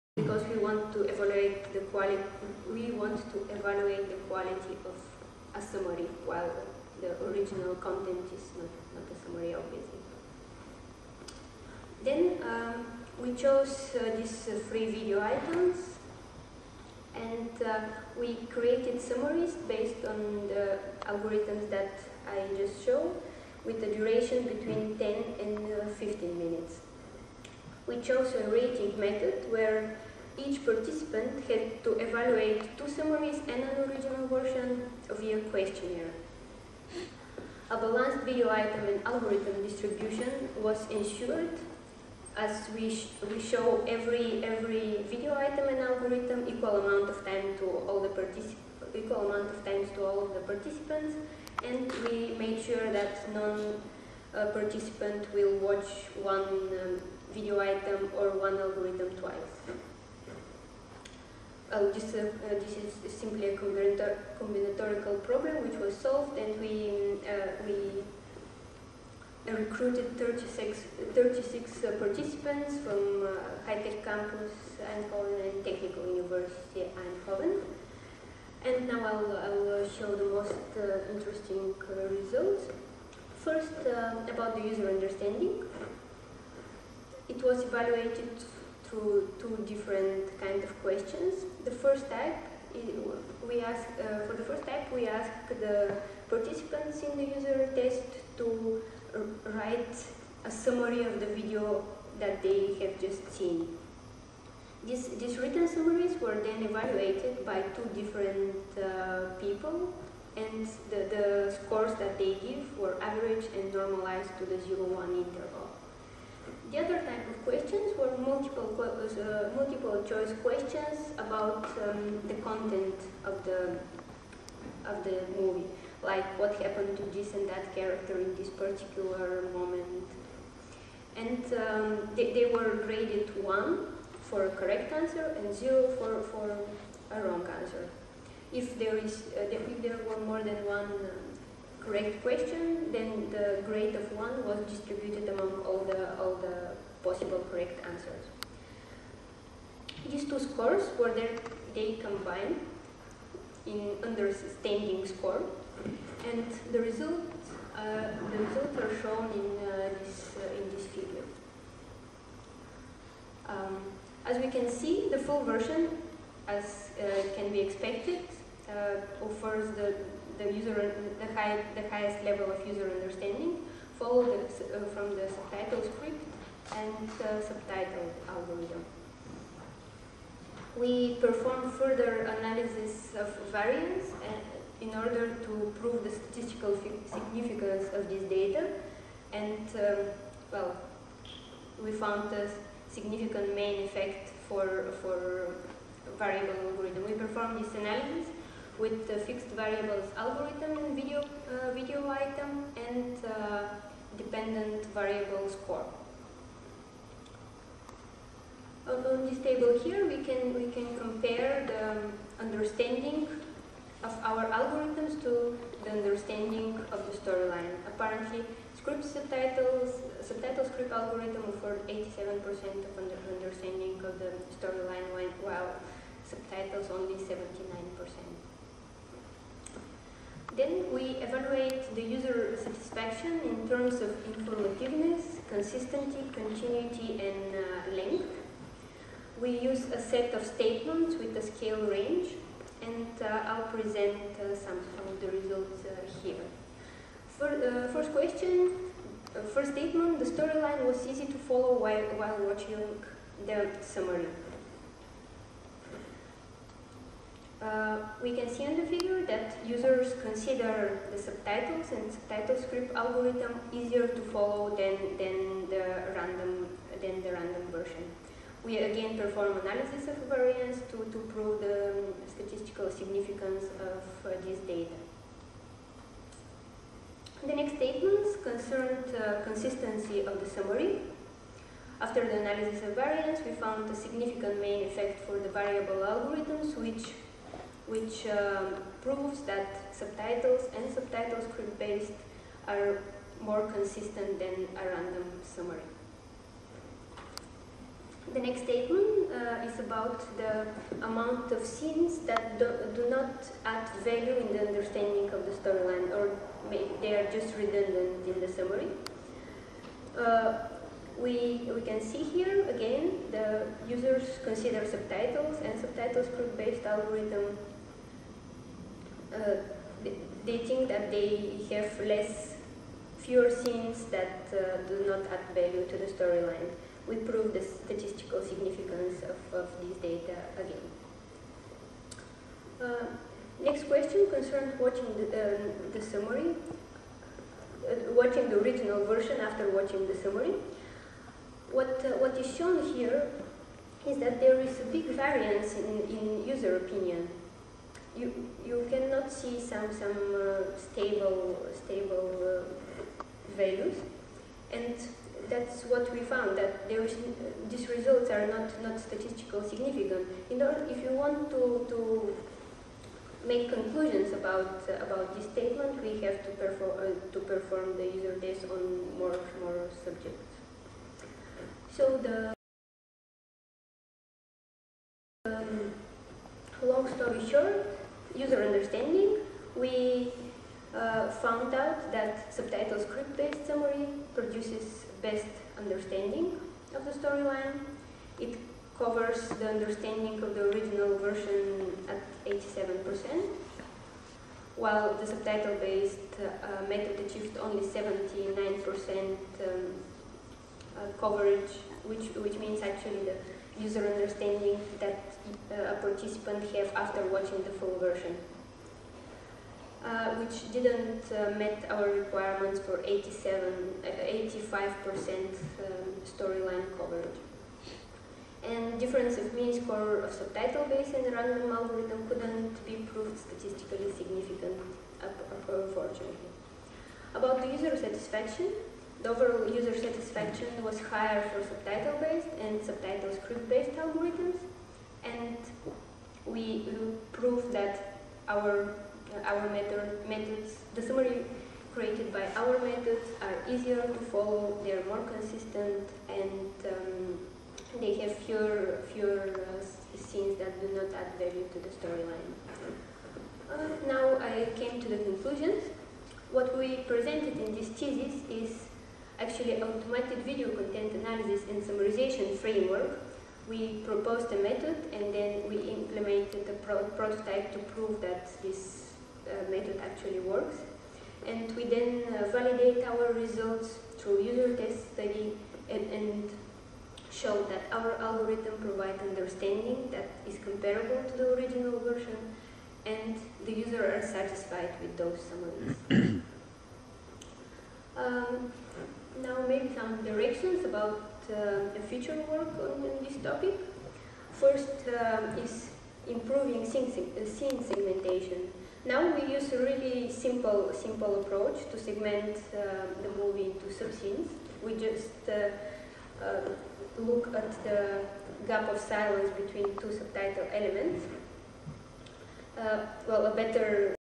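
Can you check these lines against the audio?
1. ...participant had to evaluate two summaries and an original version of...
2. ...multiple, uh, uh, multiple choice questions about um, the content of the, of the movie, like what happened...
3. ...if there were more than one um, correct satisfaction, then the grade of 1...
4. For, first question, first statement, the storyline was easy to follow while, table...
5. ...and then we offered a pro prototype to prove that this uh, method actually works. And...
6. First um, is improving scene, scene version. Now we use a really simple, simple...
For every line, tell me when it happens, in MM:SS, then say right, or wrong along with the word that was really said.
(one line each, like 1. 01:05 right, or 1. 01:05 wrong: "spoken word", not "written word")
1. 00:30 right
2. 01:58 right
3. 02:19 wrong: "question", not "satisfaction"
4. 04:07 wrong: "while", not "table"
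5. 07:45 wrong: "implemented", not "offered"
6. 08:14 wrong: "segmentation", not "version".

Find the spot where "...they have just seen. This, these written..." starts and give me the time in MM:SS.
01:42.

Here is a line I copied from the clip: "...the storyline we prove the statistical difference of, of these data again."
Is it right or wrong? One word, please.
wrong.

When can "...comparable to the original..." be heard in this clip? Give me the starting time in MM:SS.
08:00.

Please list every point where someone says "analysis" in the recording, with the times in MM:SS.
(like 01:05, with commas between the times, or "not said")
03:02, 03:17, 04:29, 04:42, 07:41.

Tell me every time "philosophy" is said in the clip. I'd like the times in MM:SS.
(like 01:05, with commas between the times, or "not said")
not said.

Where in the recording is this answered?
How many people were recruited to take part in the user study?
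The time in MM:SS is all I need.
01:11.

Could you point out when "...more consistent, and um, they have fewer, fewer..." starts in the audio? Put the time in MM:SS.
07:25.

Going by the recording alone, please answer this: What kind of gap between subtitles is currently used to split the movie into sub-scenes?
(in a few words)
gap of silence.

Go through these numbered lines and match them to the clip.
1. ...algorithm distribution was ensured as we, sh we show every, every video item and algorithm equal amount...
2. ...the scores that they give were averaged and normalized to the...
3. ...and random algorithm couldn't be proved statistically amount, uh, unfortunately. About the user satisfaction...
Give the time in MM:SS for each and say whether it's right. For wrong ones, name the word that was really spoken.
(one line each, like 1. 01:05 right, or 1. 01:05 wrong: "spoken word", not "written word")
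1. 00:39 right
2. 01:51 right
3. 07:01 wrong: "significant", not "amount".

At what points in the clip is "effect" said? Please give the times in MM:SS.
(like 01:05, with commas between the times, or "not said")
03:13, 04:44.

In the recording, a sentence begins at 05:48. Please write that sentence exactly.
You, you cannot see some, some uh, stable, stable uh, values.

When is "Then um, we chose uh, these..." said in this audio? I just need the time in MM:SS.
00:12.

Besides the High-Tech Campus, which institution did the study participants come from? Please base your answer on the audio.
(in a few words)
Technical University Eindhoven.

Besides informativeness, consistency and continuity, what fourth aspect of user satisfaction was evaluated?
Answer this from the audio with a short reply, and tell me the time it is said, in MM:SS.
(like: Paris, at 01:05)
length, at 03:57.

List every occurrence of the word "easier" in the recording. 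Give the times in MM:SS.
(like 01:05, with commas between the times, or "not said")
04:23, 07:23.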